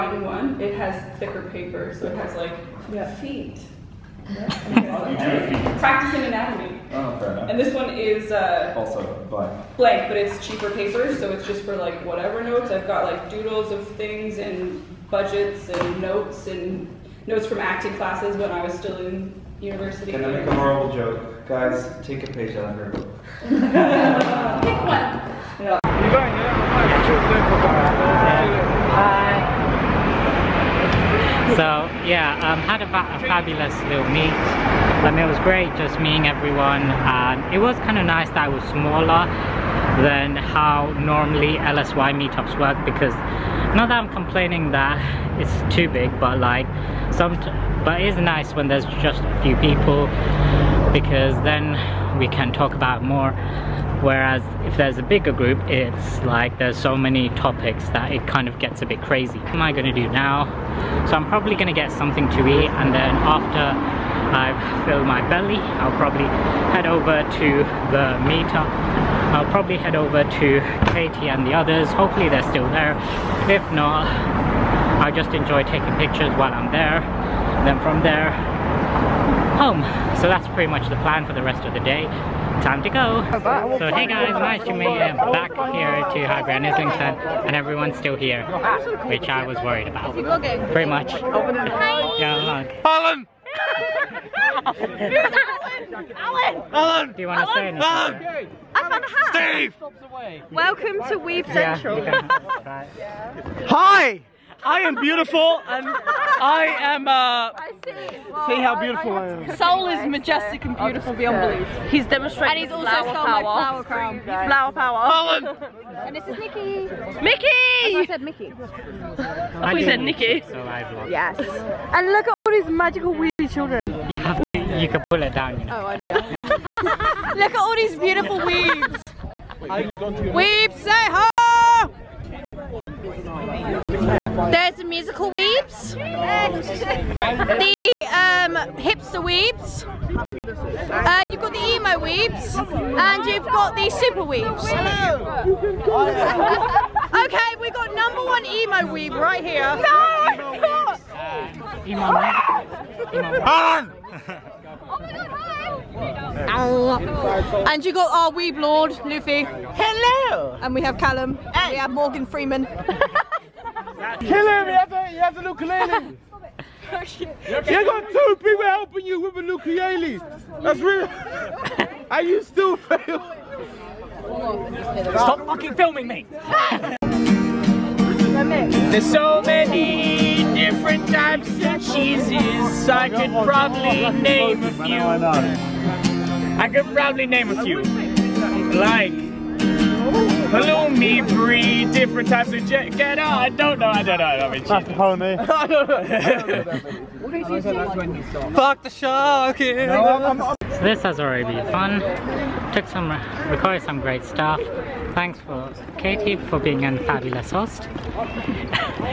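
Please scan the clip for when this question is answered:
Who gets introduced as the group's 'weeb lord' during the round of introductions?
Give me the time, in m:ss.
2:39.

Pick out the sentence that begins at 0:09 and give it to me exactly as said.
Blank, but it's cheaper paper, so it's just for like whatever notes.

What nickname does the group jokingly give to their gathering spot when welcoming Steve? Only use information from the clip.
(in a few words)
Weeb Central.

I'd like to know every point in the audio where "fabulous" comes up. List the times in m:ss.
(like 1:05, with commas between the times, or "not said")
0:33, 3:27.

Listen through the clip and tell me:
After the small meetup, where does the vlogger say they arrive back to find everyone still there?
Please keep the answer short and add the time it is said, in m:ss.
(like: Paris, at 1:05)
Highbury and Islington, at 1:26.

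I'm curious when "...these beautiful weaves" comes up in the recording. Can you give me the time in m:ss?
2:07.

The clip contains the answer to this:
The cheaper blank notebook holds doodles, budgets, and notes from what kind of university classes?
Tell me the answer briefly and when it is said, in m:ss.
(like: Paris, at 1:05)
acting classes, at 0:17.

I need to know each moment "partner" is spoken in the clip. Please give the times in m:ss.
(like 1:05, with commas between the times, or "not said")
not said.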